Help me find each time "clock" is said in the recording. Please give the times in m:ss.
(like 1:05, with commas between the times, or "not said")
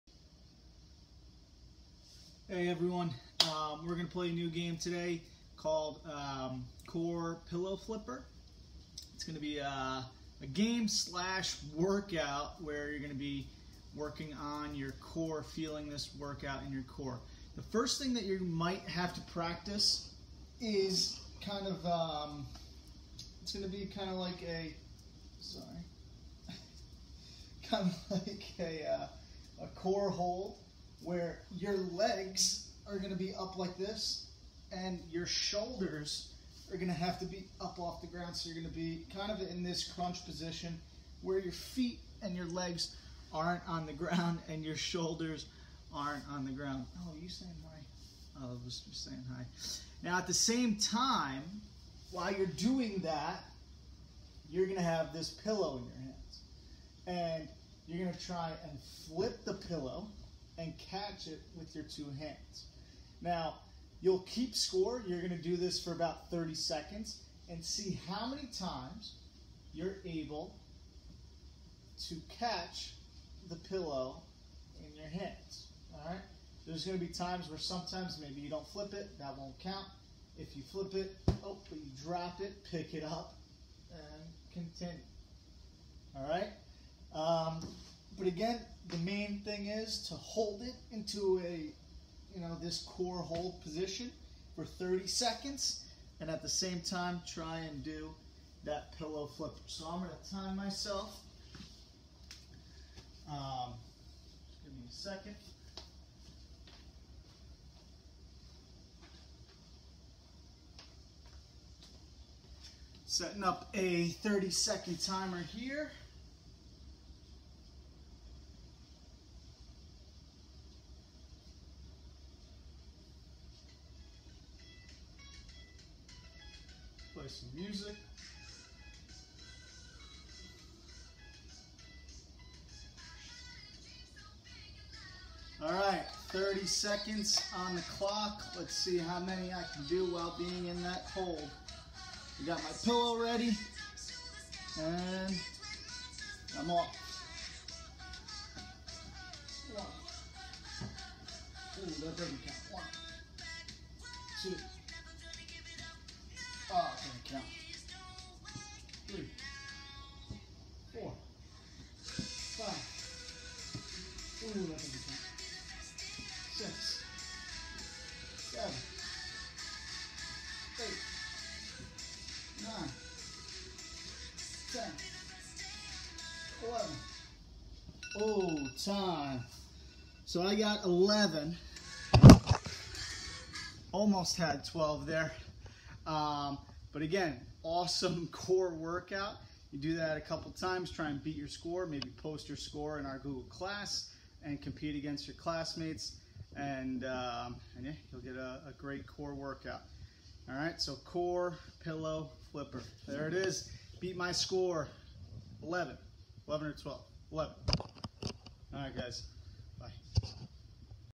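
2:17.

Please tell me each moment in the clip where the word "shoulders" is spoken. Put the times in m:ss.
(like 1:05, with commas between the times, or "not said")
0:35, 0:44.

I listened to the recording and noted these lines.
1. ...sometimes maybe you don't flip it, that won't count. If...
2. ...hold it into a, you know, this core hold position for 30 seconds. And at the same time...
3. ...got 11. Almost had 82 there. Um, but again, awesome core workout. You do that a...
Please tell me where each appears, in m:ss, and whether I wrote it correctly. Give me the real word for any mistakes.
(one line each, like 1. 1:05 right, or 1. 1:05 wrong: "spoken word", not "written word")
1. 1:17 right
2. 1:30 right
3. 3:00 wrong: "12", not "82".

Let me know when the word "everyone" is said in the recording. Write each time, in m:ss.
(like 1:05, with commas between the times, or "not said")
0:02.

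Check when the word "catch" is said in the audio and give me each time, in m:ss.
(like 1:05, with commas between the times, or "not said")
1:00, 1:12.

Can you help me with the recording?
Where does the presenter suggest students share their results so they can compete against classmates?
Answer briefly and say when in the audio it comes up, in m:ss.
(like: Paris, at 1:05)
Google class, at 3:13.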